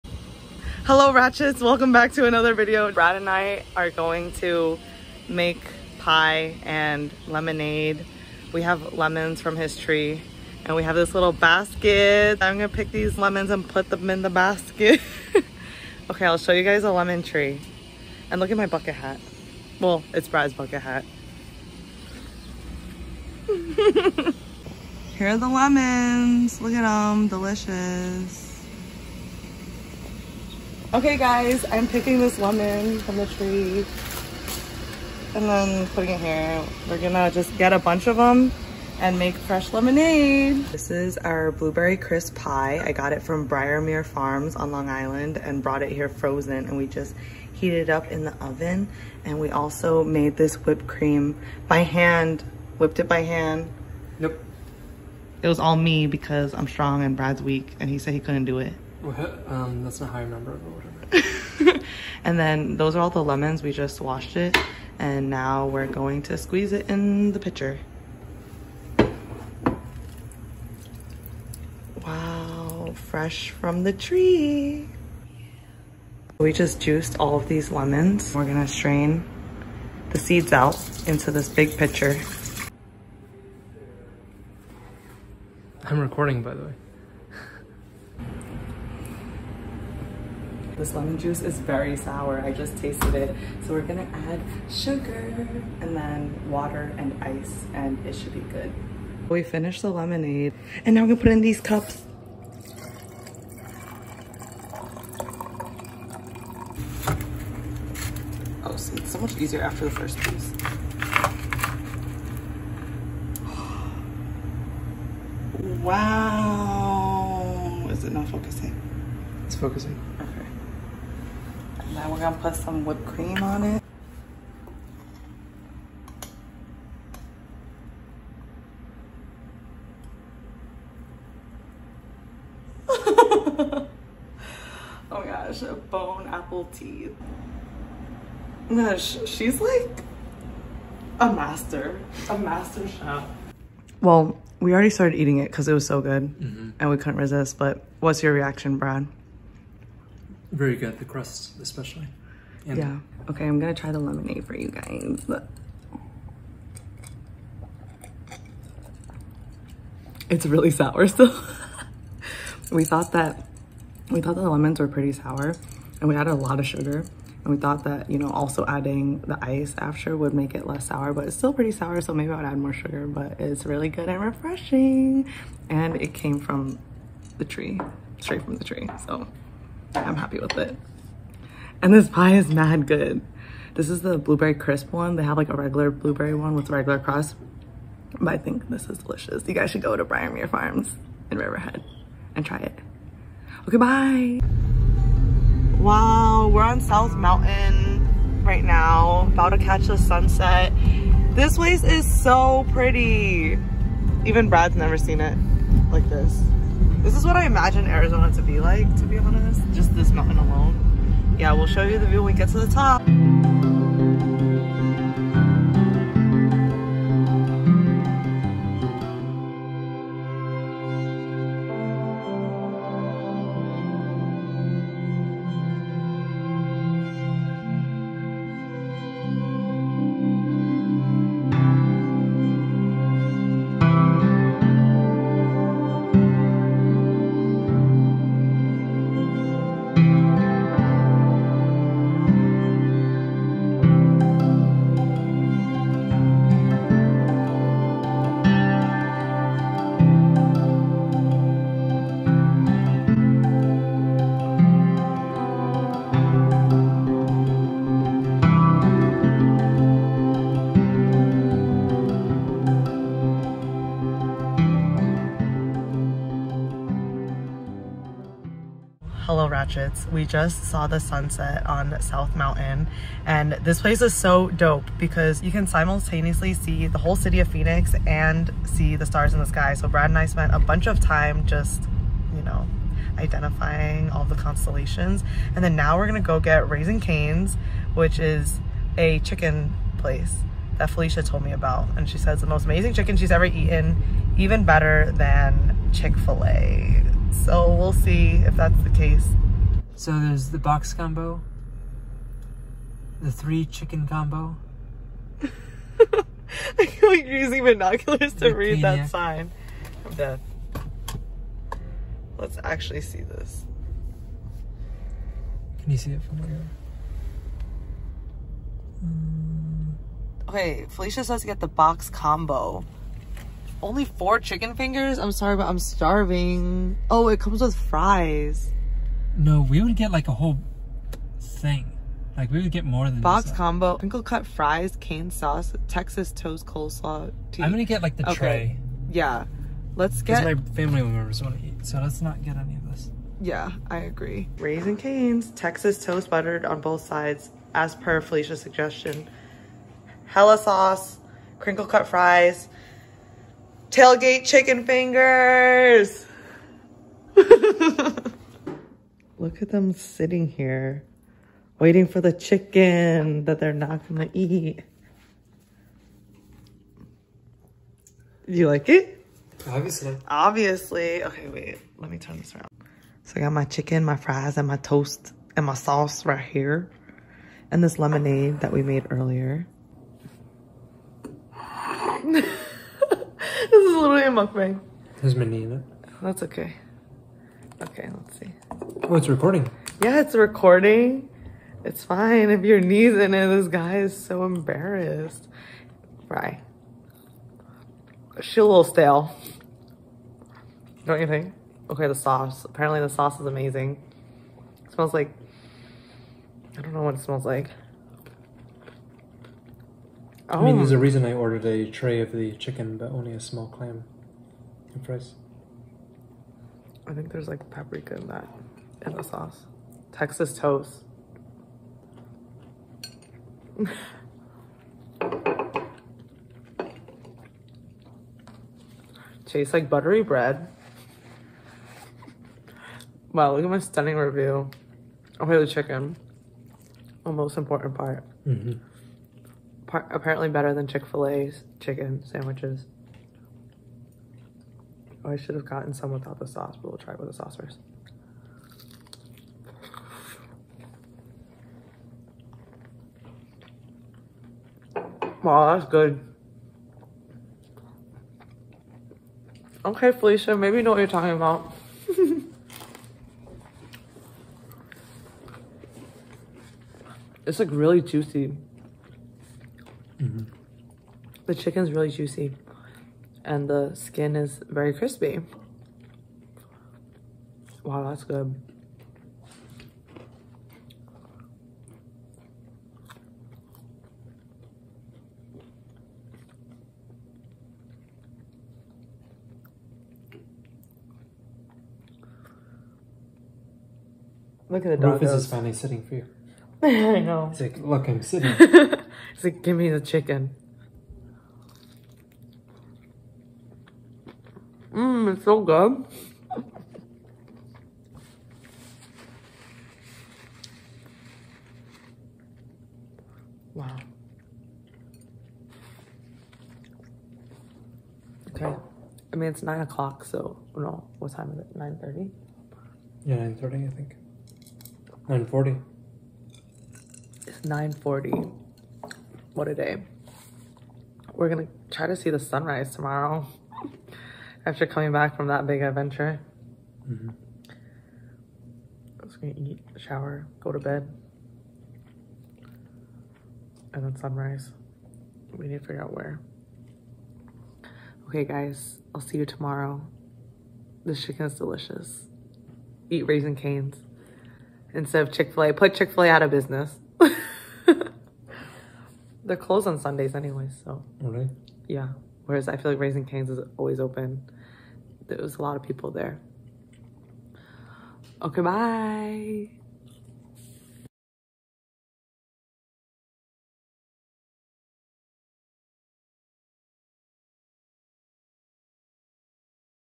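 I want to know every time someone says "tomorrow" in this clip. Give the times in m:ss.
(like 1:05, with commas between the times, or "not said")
8:52, 9:09.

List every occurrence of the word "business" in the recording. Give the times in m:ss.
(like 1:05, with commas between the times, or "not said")
9:16.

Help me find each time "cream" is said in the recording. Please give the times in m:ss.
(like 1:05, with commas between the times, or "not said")
0:50, 2:03.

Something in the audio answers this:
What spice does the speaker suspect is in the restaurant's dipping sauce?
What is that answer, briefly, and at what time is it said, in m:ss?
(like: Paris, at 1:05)
Paprika, at 6:57.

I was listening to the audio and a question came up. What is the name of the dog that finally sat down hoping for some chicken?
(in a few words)
Rufus.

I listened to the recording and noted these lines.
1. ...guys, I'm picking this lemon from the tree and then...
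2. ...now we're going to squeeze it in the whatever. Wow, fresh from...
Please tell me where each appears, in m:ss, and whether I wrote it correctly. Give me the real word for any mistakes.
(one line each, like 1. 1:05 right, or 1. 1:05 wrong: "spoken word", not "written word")
1. 0:31 right
2. 1:05 wrong: "pitcher", not "whatever".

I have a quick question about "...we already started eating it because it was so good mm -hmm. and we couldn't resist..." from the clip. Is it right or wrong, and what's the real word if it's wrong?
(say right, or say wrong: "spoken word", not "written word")
right.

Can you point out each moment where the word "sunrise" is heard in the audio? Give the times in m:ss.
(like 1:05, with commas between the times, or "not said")
8:52, 9:04.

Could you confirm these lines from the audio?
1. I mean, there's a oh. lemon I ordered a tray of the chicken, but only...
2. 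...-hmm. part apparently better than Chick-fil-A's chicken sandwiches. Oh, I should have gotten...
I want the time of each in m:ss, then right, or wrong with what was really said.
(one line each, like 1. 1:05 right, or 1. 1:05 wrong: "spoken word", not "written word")
1. 6:50 wrong: "reason", not "lemon"
2. 7:18 right.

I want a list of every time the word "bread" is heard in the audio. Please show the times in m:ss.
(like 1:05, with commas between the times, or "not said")
7:10.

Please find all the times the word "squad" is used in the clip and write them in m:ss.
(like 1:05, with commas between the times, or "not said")
not said.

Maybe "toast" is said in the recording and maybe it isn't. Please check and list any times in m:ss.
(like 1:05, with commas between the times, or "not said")
5:36, 5:46, 6:14, 7:00.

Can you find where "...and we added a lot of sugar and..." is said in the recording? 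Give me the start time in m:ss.
2:46.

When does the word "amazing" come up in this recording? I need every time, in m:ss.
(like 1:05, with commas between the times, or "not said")
4:52, 6:43.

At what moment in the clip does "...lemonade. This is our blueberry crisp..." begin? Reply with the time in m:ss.
0:39.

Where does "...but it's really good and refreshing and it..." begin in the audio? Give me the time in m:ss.
2:53.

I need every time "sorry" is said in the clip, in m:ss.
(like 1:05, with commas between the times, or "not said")
5:25.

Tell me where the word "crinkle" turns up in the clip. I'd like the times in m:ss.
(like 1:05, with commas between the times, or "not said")
5:33, 5:51.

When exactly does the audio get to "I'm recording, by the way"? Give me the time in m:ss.
1:25.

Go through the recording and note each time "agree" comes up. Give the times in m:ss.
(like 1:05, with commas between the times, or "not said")
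5:43.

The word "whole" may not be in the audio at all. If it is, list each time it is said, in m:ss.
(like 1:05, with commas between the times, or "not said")
4:36, 5:30.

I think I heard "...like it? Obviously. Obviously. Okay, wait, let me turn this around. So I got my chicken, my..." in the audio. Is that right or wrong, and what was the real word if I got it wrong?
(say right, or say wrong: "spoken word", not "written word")
right.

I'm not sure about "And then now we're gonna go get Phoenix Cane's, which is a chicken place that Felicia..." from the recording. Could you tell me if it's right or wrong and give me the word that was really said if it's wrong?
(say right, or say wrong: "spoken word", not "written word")
wrong: "Raising", not "Phoenix".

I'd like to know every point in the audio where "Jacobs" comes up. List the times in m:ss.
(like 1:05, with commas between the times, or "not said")
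not said.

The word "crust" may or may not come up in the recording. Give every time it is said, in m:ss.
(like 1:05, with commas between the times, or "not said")
2:31, 3:06.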